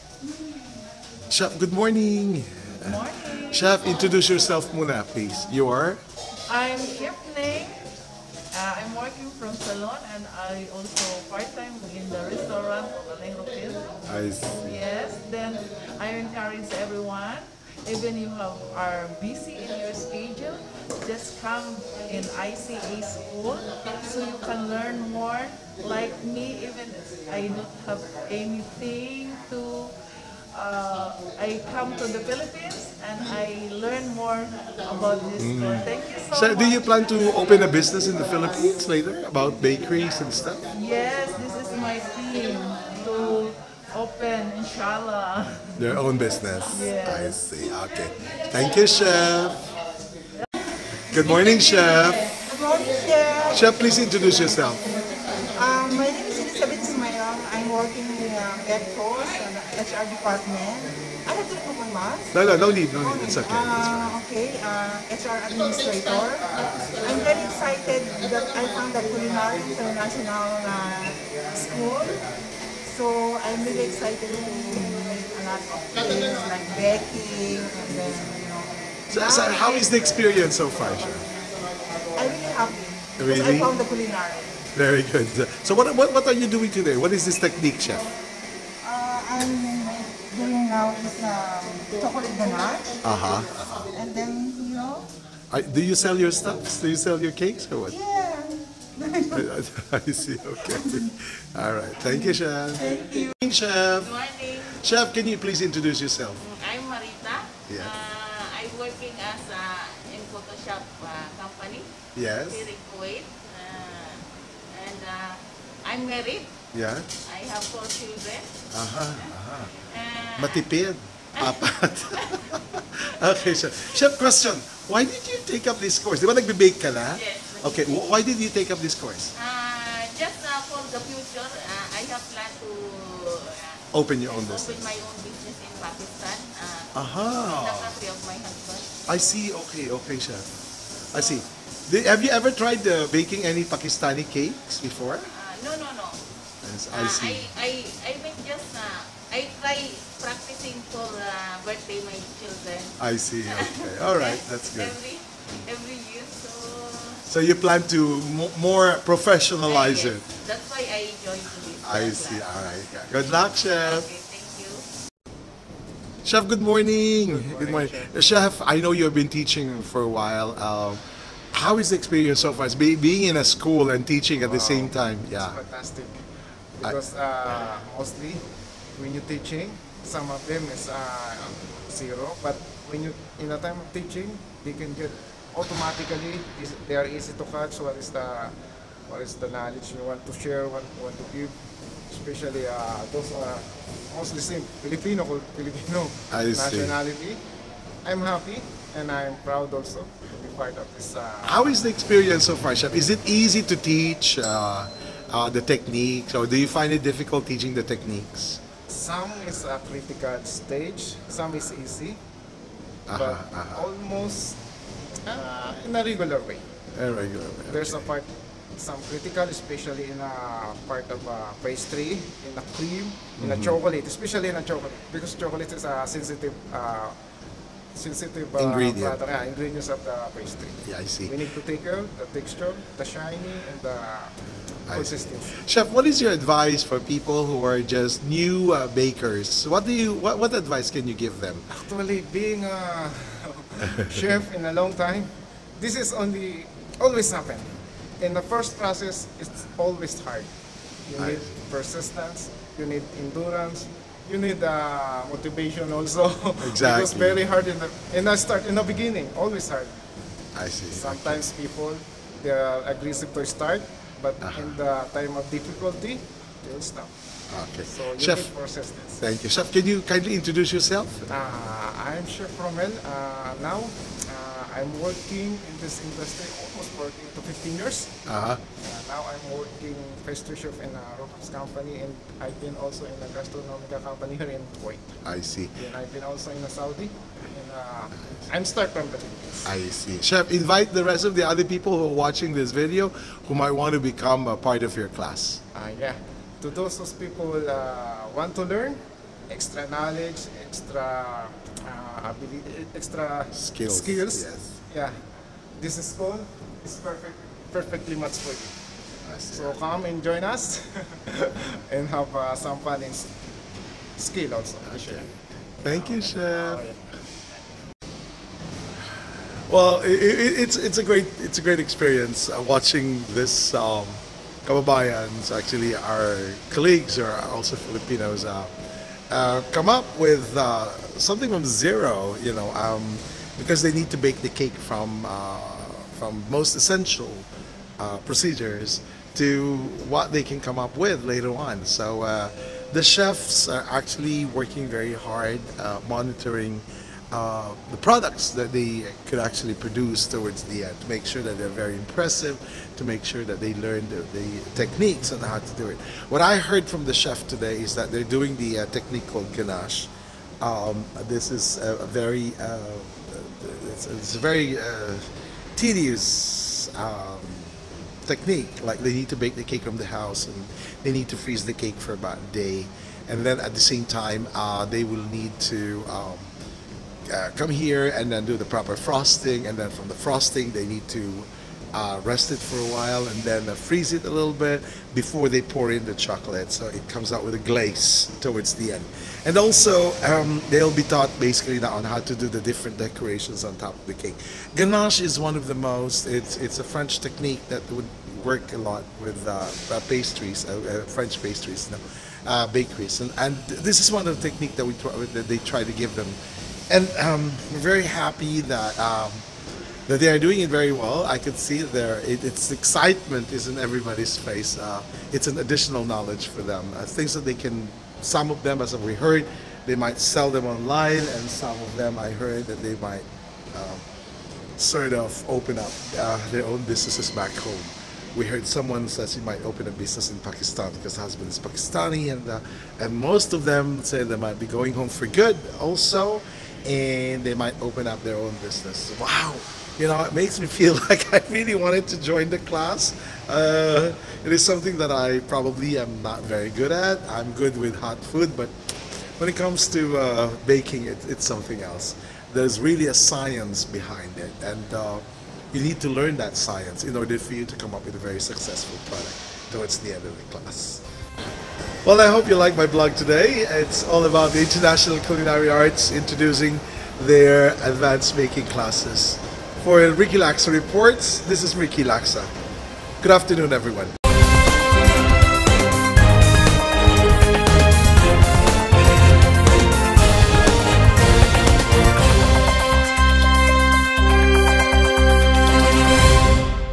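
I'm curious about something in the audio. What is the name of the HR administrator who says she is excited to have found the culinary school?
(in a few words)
Elizabeth Sumayong.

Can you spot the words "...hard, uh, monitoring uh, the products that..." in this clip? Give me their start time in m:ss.
5:45.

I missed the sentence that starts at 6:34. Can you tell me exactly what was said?
Ganache is one of the most.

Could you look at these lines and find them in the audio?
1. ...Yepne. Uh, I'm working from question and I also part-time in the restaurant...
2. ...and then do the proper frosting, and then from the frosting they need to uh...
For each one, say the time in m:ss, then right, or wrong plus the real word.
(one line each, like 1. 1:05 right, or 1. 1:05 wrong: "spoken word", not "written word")
1. 0:07 wrong: "salon", not "question"
2. 6:18 right.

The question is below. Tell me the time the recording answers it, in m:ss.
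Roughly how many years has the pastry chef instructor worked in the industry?
4:37.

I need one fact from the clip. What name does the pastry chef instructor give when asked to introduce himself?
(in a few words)
Romel.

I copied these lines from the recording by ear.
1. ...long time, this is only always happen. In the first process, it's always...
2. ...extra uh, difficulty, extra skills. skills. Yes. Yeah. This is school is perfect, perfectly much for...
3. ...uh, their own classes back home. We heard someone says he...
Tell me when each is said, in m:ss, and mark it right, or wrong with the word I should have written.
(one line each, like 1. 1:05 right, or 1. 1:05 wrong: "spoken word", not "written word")
1. 4:04 right
2. 5:00 wrong: "ability", not "difficulty"
3. 7:06 wrong: "businesses", not "classes".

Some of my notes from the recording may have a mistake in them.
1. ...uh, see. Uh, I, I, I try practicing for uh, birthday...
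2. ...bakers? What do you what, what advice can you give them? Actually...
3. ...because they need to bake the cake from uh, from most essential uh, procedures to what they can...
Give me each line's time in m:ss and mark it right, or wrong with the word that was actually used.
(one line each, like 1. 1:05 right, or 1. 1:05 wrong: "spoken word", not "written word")
1. 2:27 right
2. 3:58 right
3. 5:33 right.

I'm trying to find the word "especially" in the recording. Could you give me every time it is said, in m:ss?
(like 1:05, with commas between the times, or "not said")
3:12, 3:39, 3:44.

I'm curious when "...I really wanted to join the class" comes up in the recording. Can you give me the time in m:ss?
7:21.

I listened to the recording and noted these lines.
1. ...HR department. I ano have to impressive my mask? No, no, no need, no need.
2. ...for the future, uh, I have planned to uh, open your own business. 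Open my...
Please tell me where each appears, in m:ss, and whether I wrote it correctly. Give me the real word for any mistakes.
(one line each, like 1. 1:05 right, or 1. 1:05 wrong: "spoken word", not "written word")
1. 0:59 wrong: "remove", not "impressive"
2. 2:10 right.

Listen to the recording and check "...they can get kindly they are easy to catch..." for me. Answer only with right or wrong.
wrong.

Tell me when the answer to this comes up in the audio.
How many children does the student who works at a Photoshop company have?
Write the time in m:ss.
1:57.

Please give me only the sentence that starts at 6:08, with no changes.
Like they need to bake the cake from the house and they need to freeze the cake for about a day.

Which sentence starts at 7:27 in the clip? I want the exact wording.
I'm good with hot food, but when it comes to uh, baking, it, it's something else.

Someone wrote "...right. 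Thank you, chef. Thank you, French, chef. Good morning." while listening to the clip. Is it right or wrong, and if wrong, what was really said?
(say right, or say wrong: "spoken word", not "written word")
wrong: "Morning", not "French".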